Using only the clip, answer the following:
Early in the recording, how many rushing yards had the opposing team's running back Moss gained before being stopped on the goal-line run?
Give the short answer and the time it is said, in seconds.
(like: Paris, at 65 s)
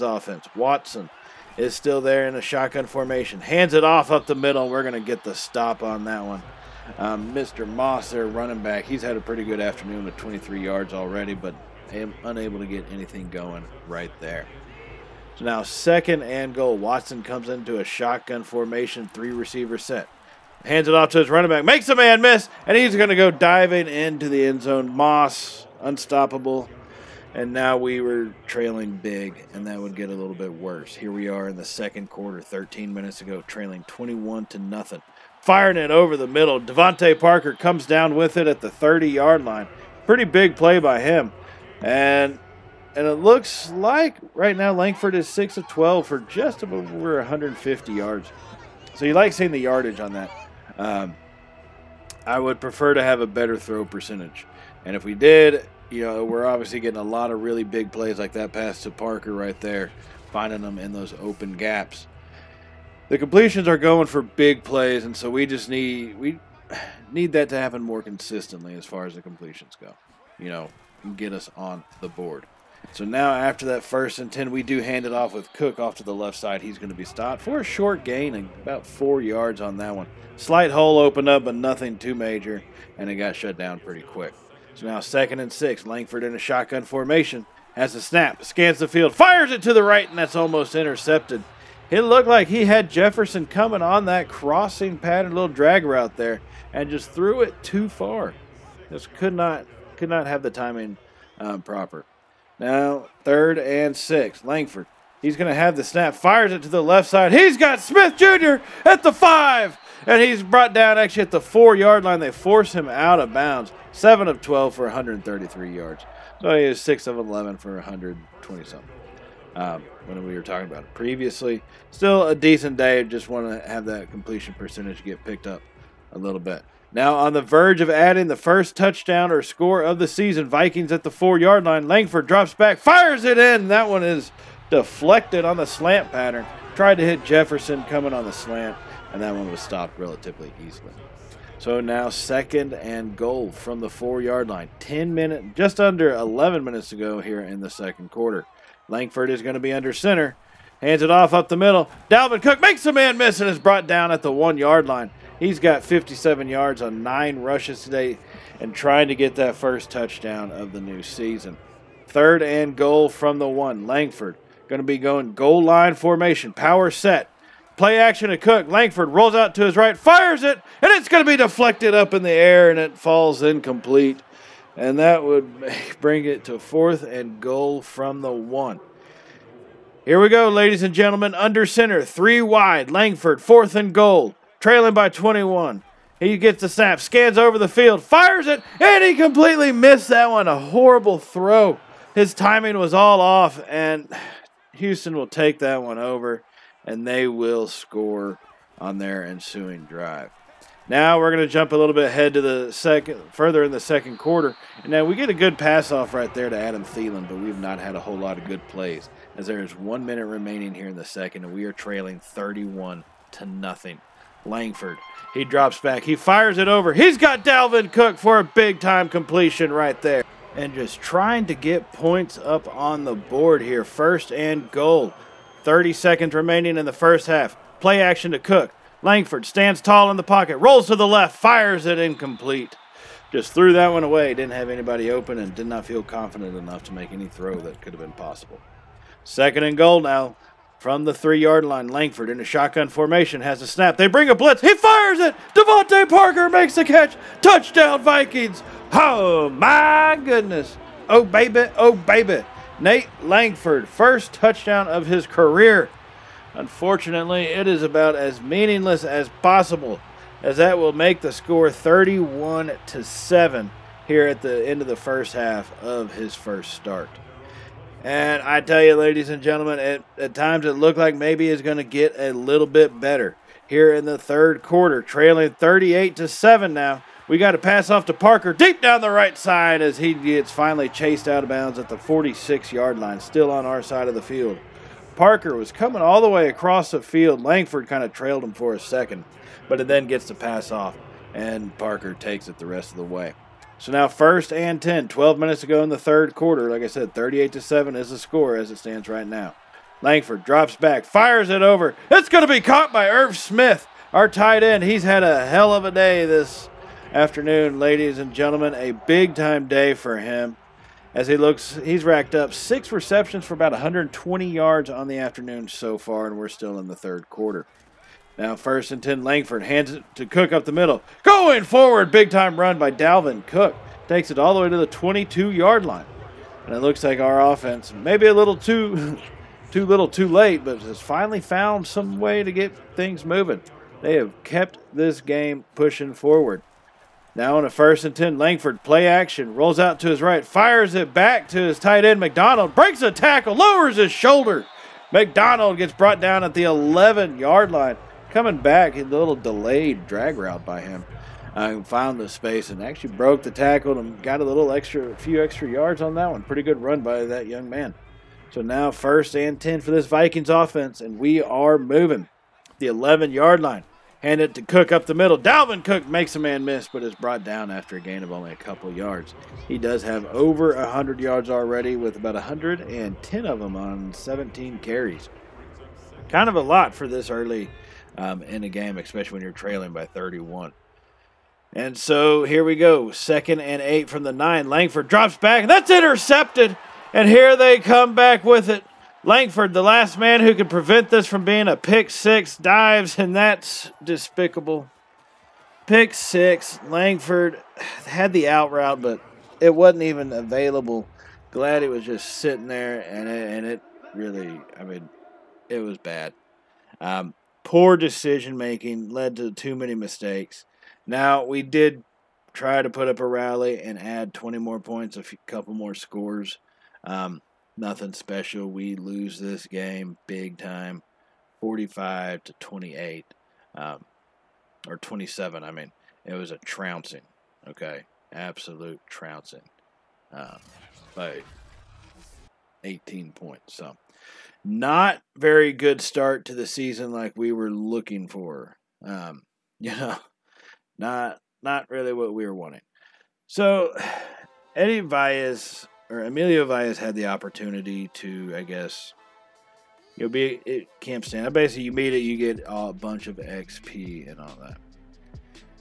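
23 yards, at 10 s.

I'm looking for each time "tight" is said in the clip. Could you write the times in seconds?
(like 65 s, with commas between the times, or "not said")
304 s, 341 s.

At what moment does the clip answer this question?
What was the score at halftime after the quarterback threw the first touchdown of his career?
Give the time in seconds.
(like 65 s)
261 s.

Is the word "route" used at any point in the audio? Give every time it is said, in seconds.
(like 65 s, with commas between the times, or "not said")
95 s, 350 s, 398 s.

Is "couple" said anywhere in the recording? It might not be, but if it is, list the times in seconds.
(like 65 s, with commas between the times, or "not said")
368 s, 415 s.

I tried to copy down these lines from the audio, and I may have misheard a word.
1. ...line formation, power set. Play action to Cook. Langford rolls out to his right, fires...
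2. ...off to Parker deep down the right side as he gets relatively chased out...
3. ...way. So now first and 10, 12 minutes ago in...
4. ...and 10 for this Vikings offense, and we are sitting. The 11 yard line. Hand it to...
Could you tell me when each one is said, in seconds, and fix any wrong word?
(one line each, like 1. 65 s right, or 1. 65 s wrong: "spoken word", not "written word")
1. 165 s right
2. 277 s wrong: "finally", not "relatively"
3. 293 s right
4. 359 s wrong: "moving", not "sitting".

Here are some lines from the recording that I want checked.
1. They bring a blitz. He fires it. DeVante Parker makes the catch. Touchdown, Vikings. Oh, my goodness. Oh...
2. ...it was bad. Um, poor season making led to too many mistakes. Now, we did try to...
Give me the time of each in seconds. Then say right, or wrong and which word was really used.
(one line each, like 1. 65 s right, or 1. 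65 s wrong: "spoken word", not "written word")
1. 243 s right
2. 405 s wrong: "decision", not "season".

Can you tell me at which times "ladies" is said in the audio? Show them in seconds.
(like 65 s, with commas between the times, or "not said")
180 s, 268 s, 307 s.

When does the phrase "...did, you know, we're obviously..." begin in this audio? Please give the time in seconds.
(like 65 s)
55 s.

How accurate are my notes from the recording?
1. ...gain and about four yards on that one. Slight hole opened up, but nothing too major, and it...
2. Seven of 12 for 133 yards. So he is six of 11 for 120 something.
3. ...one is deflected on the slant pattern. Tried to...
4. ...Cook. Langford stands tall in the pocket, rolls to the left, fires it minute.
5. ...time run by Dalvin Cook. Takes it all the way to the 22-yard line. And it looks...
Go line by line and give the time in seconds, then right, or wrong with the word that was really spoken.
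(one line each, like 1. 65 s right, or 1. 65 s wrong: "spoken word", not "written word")
1. 78 s right
2. 113 s right
3. 133 s right
4. 228 s wrong: "incomplete", not "minute"
5. 322 s right.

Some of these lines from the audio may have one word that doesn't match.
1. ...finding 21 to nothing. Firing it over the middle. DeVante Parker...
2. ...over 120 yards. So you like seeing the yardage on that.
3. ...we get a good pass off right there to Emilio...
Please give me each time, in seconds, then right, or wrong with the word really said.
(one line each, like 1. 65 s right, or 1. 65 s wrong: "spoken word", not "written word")
1. 33 s wrong: "trailing", not "finding"
2. 46 s wrong: "150", not "120"
3. 205 s wrong: "Adam", not "Emilio".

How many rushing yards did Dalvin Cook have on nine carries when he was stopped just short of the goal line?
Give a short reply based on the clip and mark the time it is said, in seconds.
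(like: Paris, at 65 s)
57, at 155 s.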